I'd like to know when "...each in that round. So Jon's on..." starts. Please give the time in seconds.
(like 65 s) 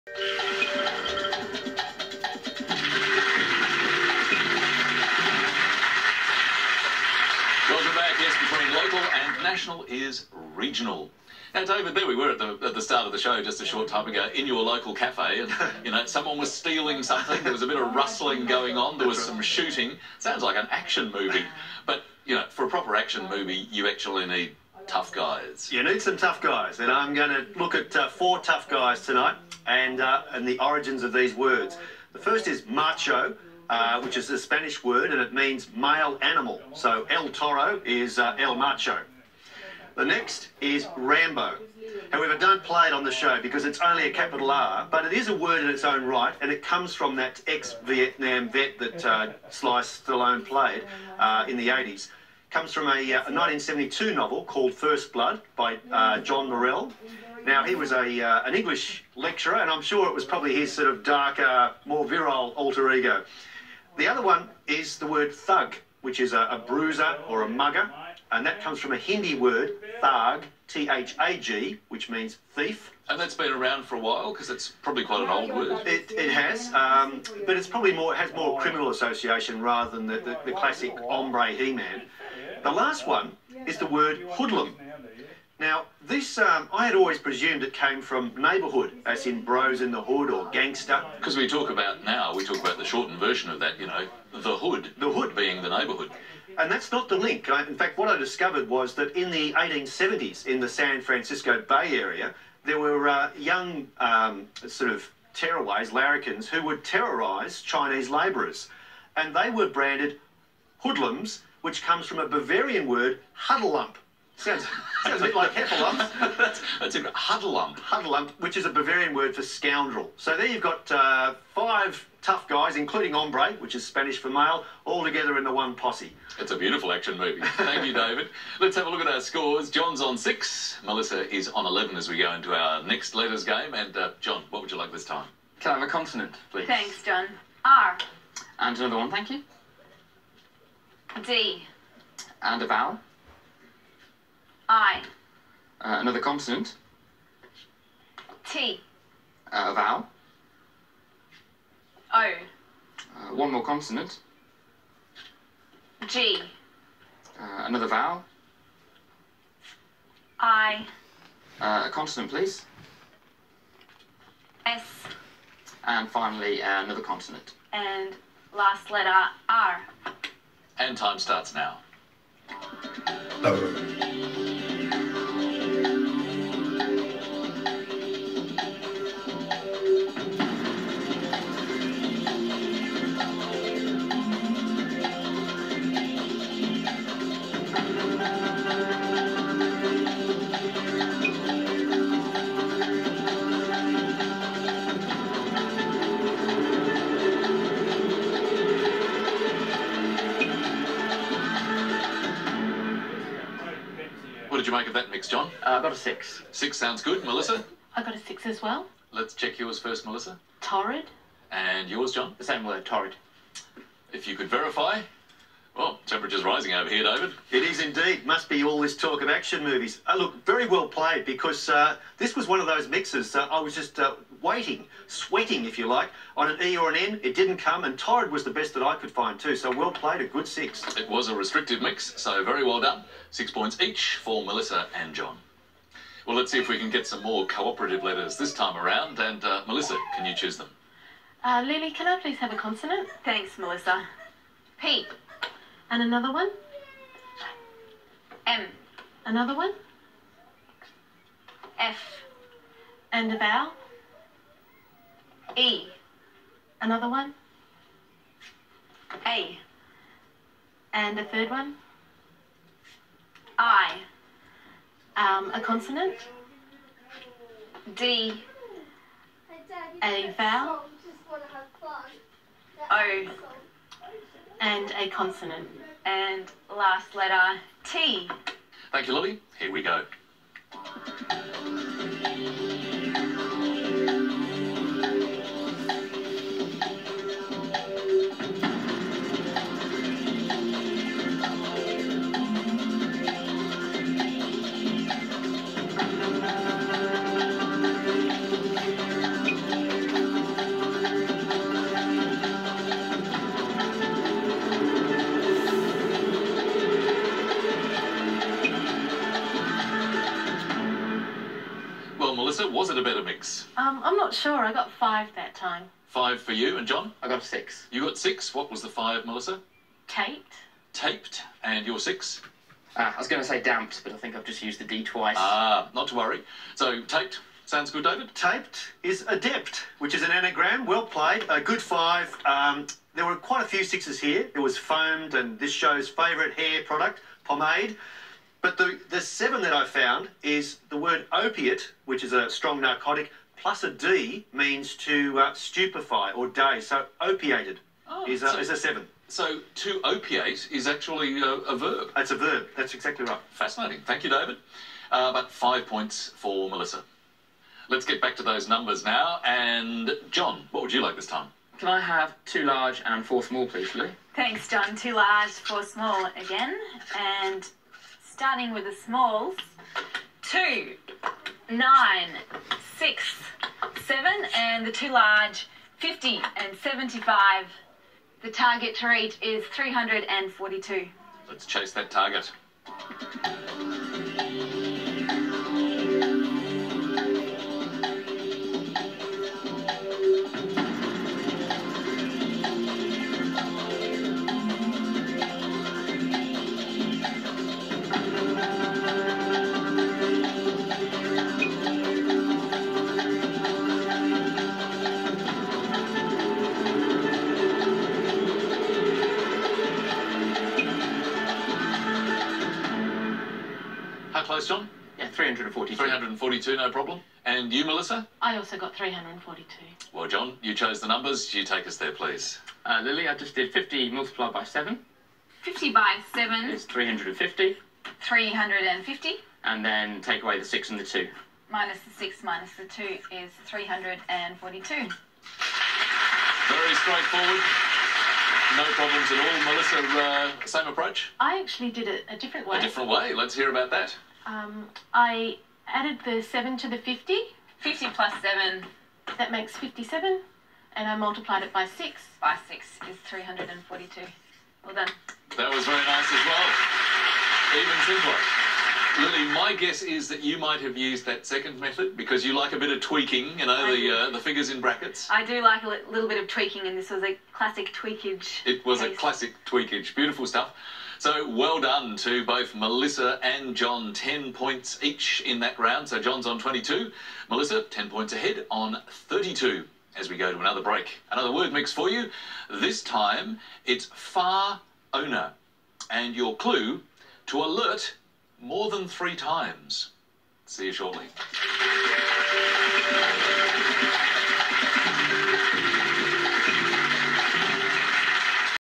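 475 s.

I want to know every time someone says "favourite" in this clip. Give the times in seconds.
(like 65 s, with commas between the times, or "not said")
336 s.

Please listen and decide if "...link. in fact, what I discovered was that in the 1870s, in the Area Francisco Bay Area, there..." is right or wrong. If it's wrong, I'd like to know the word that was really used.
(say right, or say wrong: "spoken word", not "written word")
wrong: "San", not "Area".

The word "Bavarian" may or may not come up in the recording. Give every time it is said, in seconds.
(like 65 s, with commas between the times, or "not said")
112 s, 118 s.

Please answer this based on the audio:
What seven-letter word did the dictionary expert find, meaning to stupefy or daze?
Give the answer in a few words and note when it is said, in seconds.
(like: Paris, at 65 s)
opiated, at 347 s.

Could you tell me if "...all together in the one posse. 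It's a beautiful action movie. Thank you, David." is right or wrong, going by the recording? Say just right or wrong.
right.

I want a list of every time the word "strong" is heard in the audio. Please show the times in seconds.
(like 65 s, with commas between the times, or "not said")
342 s.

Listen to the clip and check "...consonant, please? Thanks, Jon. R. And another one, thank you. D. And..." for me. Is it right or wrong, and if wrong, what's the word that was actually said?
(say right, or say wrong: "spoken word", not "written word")
right.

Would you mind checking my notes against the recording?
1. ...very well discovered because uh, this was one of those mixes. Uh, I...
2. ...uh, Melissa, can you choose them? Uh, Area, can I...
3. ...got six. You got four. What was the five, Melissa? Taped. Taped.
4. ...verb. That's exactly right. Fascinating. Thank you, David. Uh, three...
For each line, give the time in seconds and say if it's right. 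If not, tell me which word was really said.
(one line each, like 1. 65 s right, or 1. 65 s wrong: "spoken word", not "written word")
1. 220 s wrong: "played", not "discovered"
2. 239 s wrong: "Lily", not "Area"
3. 317 s wrong: "six", not "four"
4. 352 s wrong: "five", not "three".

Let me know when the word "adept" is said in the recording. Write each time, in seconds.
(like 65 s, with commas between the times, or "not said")
329 s.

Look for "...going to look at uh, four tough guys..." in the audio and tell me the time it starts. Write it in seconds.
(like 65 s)
27 s.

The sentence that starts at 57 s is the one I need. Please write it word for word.
Now, he was a, uh, an English lecturer, and I'm sure it was probably his sort of darker, more virile alter ego.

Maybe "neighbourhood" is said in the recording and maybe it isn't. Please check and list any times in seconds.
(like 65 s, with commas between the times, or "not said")
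88 s, 95 s.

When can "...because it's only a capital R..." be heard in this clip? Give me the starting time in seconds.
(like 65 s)
43 s.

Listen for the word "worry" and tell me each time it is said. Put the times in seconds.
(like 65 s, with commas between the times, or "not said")
326 s.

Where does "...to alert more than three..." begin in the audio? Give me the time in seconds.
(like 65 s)
487 s.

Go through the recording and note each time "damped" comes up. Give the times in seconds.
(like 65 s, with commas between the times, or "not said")
323 s.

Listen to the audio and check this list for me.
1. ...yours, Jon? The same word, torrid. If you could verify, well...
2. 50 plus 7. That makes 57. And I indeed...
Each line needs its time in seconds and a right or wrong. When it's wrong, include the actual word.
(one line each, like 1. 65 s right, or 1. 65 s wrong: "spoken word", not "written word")
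1. 211 s right
2. 447 s wrong: "multiplied", not "indeed".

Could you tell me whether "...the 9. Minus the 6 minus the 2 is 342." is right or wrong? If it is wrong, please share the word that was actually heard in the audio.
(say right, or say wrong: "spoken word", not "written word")
wrong: "2", not "9".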